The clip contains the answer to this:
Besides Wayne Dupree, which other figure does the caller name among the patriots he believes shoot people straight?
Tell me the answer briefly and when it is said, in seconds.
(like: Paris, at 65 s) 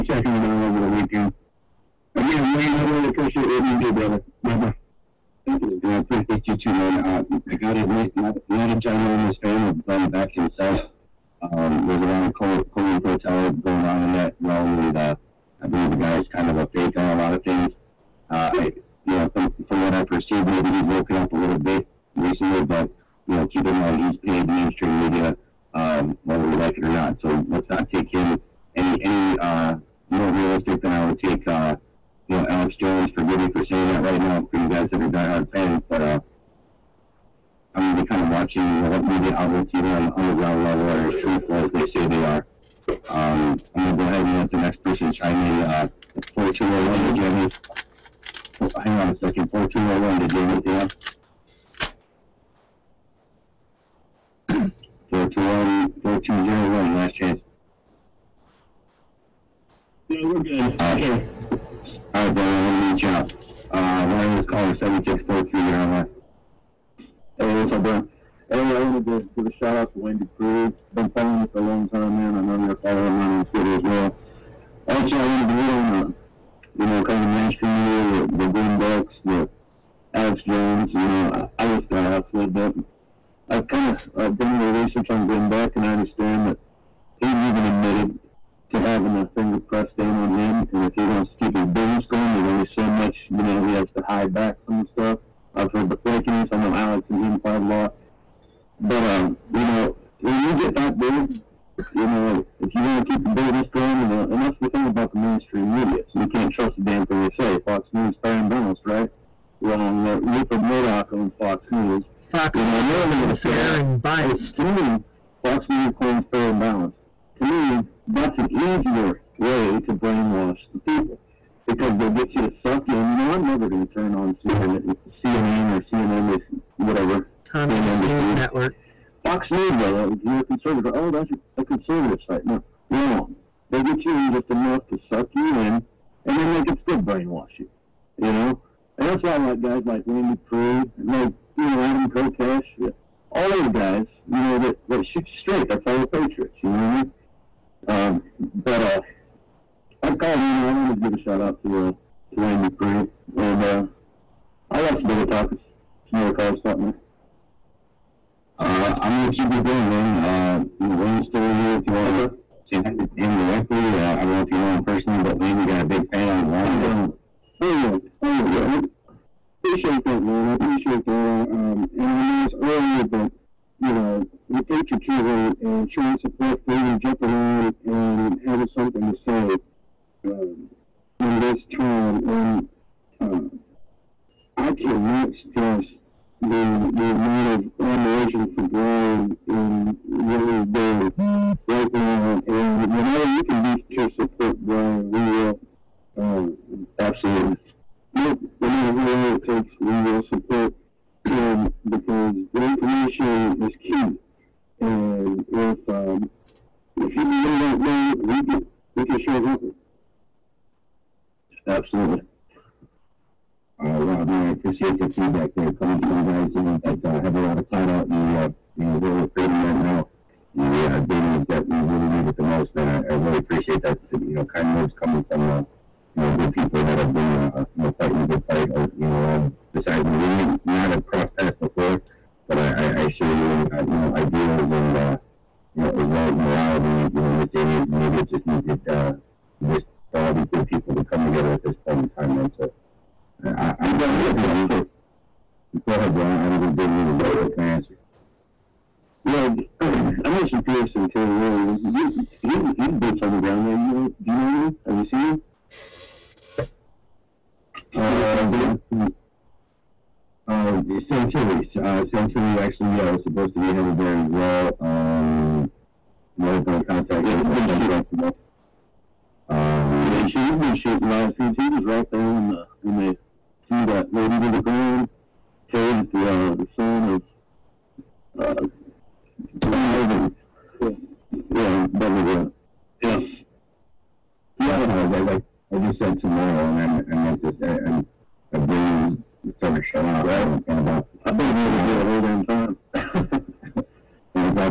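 Adam Kokesh, at 141 s.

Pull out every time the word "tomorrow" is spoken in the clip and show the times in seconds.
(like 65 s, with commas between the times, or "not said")
268 s, 286 s.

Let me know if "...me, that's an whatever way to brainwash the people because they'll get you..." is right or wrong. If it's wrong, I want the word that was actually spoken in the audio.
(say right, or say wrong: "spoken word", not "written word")
wrong: "easier", not "whatever".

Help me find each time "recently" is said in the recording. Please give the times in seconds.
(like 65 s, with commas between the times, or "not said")
22 s.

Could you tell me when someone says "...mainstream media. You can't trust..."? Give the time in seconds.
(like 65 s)
105 s.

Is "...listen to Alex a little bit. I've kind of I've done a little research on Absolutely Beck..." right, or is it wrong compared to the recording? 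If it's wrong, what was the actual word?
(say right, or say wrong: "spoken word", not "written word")
wrong: "Glenn", not "Absolutely".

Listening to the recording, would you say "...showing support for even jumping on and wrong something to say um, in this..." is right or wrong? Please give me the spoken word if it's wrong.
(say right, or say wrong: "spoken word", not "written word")
wrong: "having", not "wrong".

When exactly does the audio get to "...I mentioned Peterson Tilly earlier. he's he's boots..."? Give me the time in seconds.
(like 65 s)
250 s.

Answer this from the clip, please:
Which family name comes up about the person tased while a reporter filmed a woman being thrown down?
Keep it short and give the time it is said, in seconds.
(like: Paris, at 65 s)
Bundy, at 281 s.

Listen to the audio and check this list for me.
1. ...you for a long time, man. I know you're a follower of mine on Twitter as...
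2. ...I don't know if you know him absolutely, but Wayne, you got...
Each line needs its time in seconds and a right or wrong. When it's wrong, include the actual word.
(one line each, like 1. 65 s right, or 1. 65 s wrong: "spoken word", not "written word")
1. 71 s right
2. 164 s wrong: "personally", not "absolutely".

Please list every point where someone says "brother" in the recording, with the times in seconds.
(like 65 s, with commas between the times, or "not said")
3 s, 62 s.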